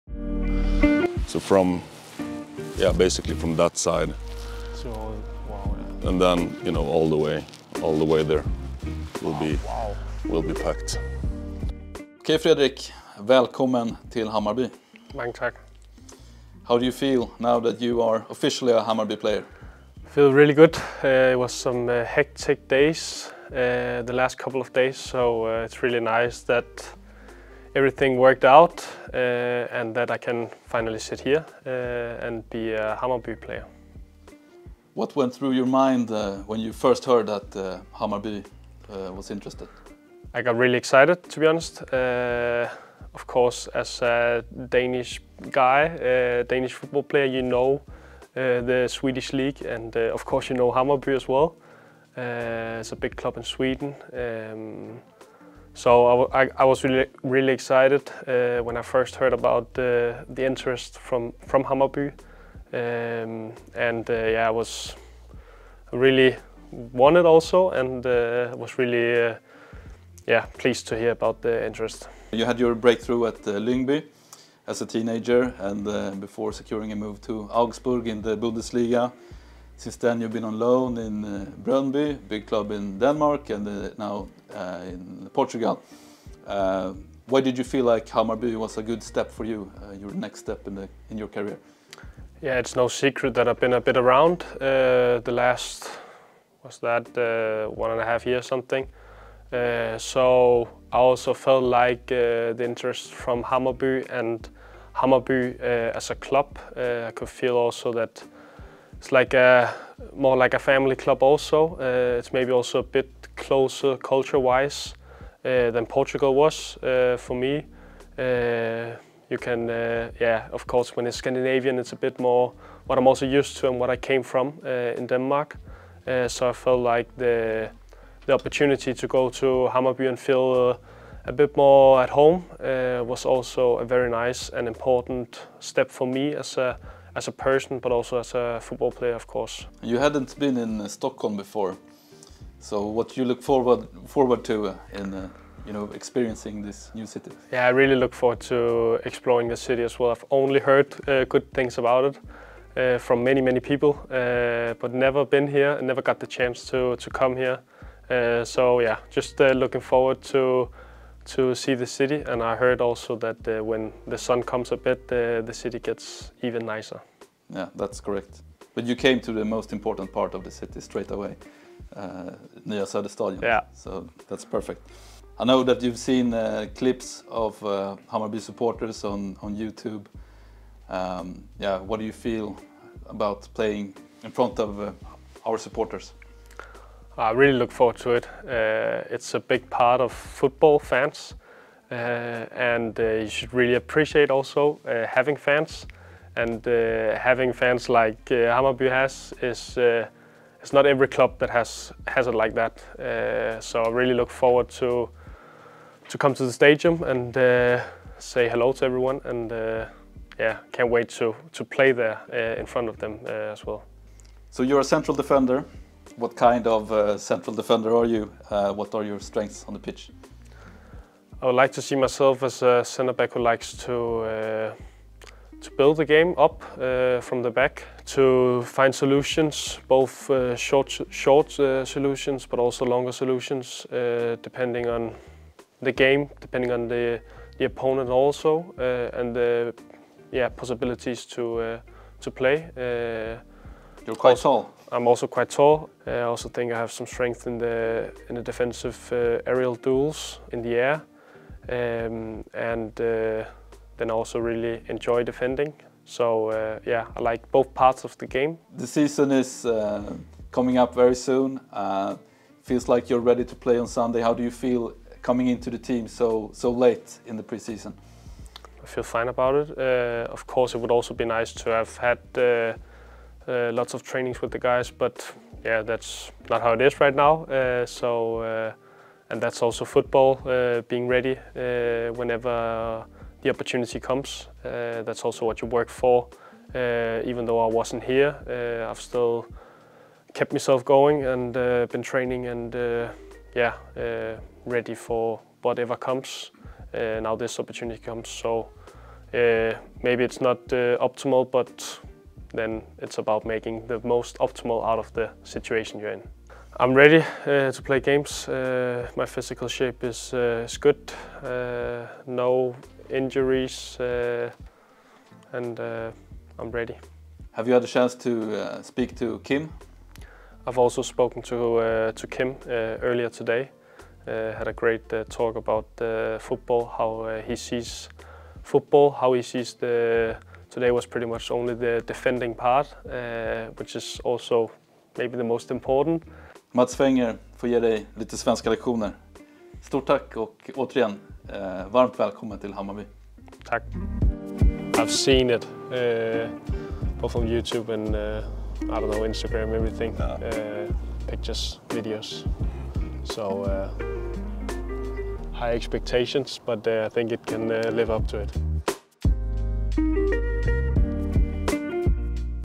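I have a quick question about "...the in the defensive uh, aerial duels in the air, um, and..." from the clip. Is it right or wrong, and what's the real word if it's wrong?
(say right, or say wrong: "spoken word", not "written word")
right.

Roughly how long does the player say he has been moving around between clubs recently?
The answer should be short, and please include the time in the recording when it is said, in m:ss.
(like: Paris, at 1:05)
One and a half years, at 1:37.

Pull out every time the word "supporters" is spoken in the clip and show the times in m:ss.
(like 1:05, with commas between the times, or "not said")
2:58, 3:05.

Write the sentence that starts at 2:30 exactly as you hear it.
I've only heard uh, good things about it.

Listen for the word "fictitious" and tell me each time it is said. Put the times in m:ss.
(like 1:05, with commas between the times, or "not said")
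not said.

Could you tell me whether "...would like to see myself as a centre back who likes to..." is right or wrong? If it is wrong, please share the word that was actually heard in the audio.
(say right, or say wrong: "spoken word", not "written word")
right.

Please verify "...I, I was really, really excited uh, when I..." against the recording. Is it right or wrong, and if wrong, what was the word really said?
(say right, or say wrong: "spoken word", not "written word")
right.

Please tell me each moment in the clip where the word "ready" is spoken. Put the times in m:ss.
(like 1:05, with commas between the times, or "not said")
4:23, 4:41, 4:54, 5:06, 5:16.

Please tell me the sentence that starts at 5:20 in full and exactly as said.
I've also spoken to, to Kim earlier today.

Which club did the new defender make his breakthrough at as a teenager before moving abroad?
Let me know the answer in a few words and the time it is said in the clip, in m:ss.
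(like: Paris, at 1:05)
Lyngby, at 1:13.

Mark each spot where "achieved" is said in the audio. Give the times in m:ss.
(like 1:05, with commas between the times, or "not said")
not said.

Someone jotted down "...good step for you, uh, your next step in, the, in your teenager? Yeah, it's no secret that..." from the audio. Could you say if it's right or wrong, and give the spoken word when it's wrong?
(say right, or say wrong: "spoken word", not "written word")
wrong: "career", not "teenager".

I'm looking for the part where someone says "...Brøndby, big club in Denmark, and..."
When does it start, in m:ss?
1:21.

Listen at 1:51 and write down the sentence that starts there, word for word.
Uh, it's maybe also a bit closer culture-wise uh, than Portugal was uh, for me.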